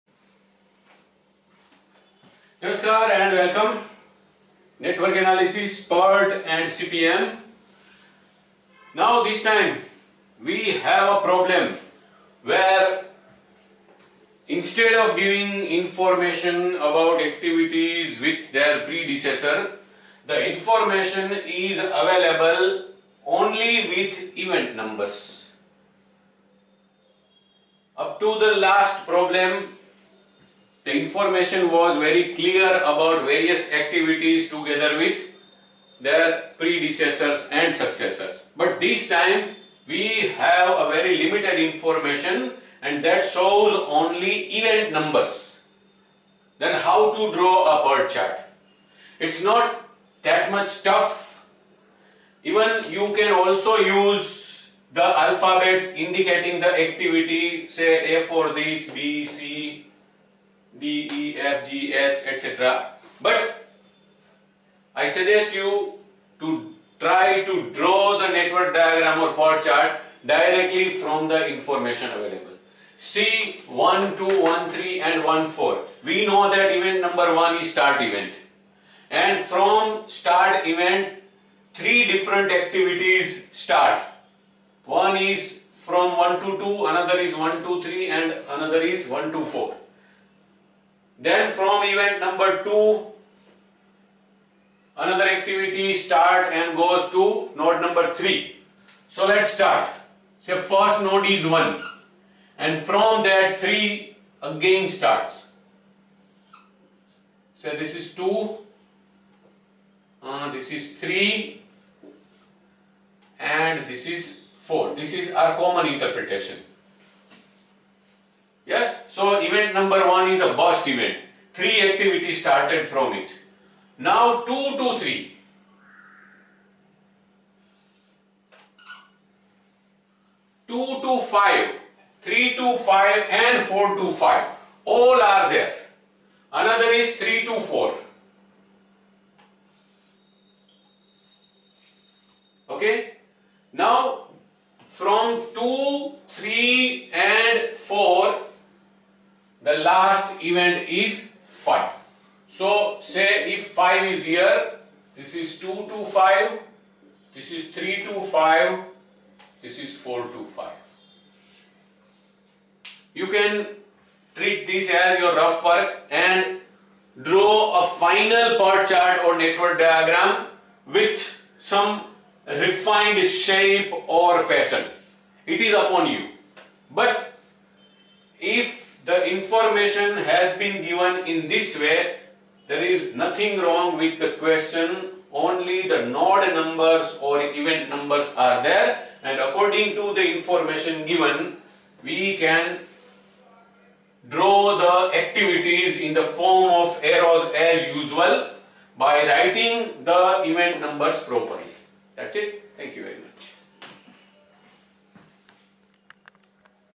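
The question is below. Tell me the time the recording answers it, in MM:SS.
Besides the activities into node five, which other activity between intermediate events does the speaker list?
02:17.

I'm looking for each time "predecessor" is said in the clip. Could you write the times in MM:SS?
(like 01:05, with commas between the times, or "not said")
00:18, 00:36.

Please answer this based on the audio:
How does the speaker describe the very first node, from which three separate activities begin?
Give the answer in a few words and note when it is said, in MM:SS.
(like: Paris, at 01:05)
Burst event, at 02:00.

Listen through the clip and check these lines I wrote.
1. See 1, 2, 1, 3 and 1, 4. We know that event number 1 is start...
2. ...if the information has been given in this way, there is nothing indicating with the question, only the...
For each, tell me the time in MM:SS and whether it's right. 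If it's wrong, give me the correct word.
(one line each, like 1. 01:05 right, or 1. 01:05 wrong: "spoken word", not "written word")
1. 01:12 right
2. 02:58 wrong: "wrong", not "indicating".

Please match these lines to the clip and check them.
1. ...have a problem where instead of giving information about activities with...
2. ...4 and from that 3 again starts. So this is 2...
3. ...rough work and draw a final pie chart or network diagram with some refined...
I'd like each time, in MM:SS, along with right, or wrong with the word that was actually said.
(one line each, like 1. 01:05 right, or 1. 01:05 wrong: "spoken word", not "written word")
1. 00:10 right
2. 01:41 wrong: "1", not "4"
3. 02:45 right.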